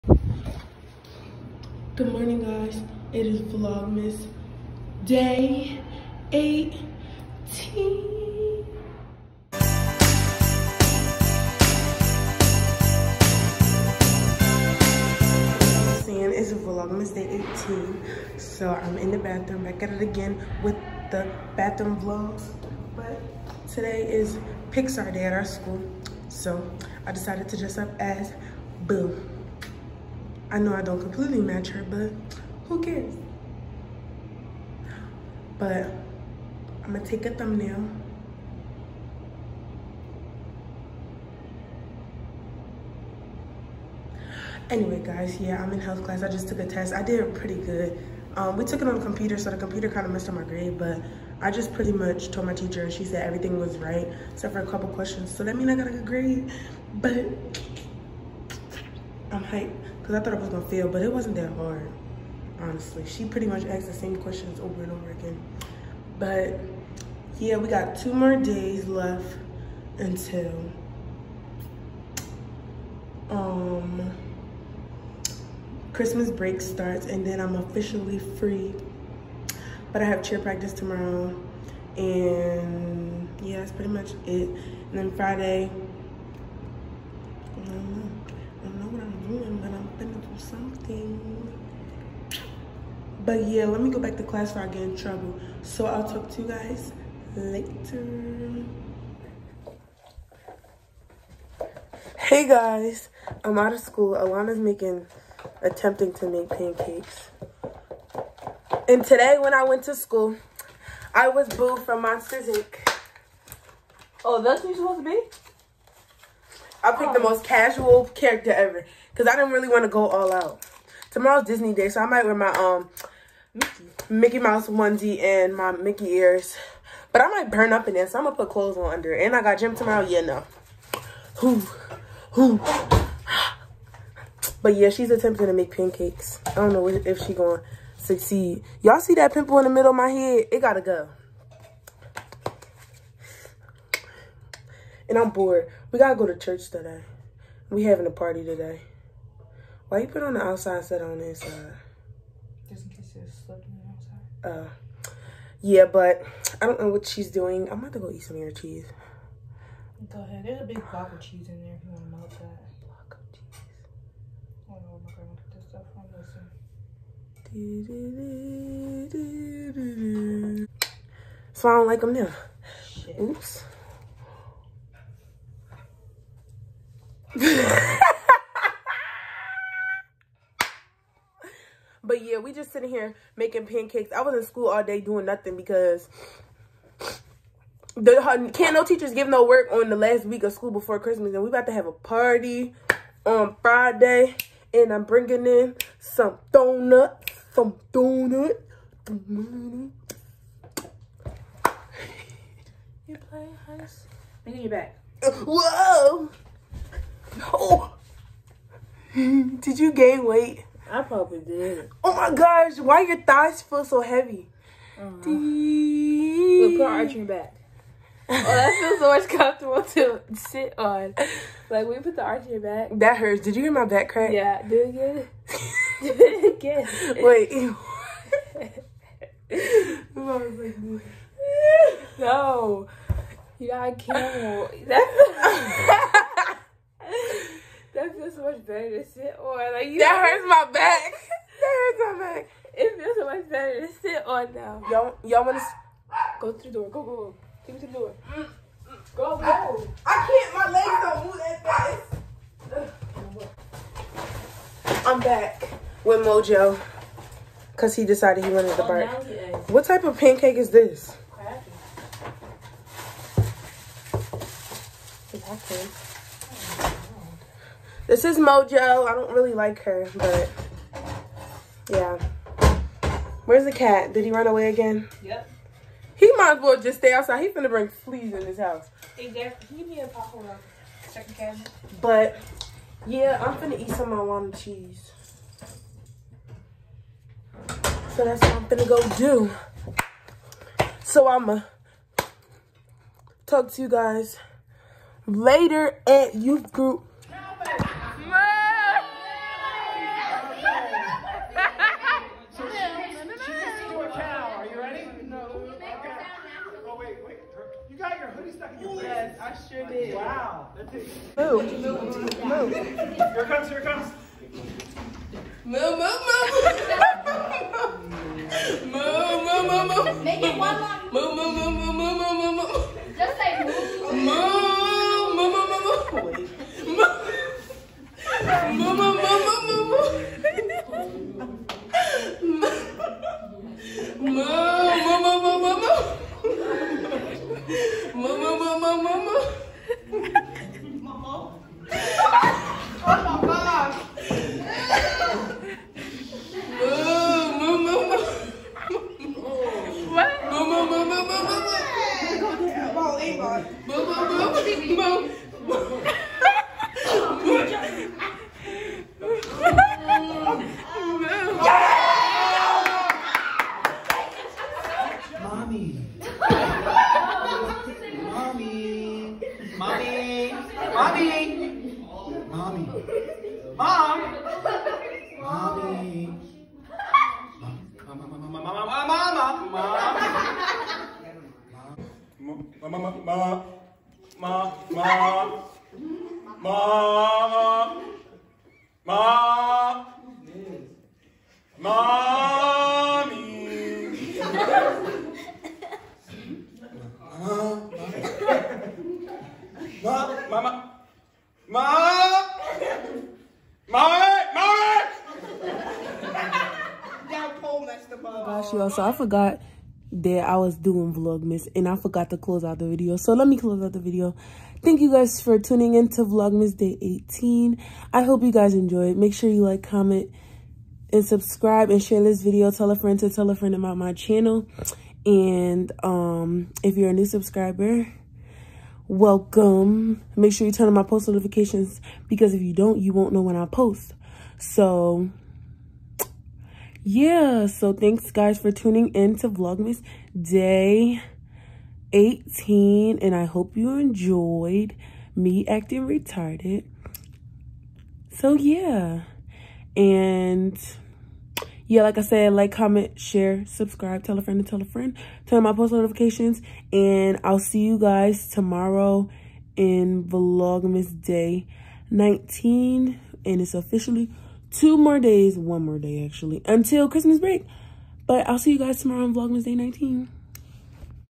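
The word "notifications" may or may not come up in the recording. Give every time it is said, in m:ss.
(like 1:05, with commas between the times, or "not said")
7:11, 7:35.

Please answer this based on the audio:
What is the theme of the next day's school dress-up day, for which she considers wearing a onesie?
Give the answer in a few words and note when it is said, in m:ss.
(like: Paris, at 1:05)
Disney Day, at 2:01.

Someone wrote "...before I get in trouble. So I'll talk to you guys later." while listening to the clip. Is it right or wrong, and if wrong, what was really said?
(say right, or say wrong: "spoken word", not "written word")
right.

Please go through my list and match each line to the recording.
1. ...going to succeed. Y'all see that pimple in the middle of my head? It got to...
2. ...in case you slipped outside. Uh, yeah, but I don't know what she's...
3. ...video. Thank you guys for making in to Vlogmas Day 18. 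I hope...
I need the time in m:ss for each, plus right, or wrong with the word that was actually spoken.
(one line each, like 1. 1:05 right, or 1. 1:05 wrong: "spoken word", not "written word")
1. 2:17 right
2. 2:32 right
3. 6:53 wrong: "tuning", not "making".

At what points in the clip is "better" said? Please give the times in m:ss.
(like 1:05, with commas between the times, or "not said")
3:58, 4:03.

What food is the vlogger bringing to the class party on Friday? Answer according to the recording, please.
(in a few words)
donuts.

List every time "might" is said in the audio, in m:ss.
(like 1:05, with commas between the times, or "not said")
2:02, 2:07, 4:36.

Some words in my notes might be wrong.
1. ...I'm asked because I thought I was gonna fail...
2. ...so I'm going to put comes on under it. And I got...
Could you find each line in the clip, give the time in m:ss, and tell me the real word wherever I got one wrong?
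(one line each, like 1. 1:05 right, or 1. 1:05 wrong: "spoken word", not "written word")
1. 0:59 wrong: "hyped", not "asked"
2. 2:08 wrong: "clothes", not "comes".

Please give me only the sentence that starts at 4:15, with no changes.
I'm back with Mojo because he decided he wanted the oh, bark.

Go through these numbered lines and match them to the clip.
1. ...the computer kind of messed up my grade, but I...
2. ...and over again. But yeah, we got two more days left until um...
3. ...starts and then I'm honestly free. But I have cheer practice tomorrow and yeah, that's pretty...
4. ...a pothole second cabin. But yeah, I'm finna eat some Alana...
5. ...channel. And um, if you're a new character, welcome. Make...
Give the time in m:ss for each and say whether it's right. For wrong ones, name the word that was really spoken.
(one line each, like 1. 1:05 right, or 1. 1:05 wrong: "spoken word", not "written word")
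1. 0:49 right
2. 1:04 right
3. 1:16 wrong: "officially", not "honestly"
4. 4:40 right
5. 7:04 wrong: "subscriber", not "character".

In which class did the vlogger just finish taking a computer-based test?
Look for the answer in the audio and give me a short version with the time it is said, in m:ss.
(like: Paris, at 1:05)
health class, at 0:45.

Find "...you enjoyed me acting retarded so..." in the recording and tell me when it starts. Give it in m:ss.
7:23.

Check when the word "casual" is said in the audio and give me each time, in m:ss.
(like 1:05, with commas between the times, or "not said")
1:57.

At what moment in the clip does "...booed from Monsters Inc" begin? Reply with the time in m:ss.
1:51.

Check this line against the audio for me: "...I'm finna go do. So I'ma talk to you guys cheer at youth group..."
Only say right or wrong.
wrong.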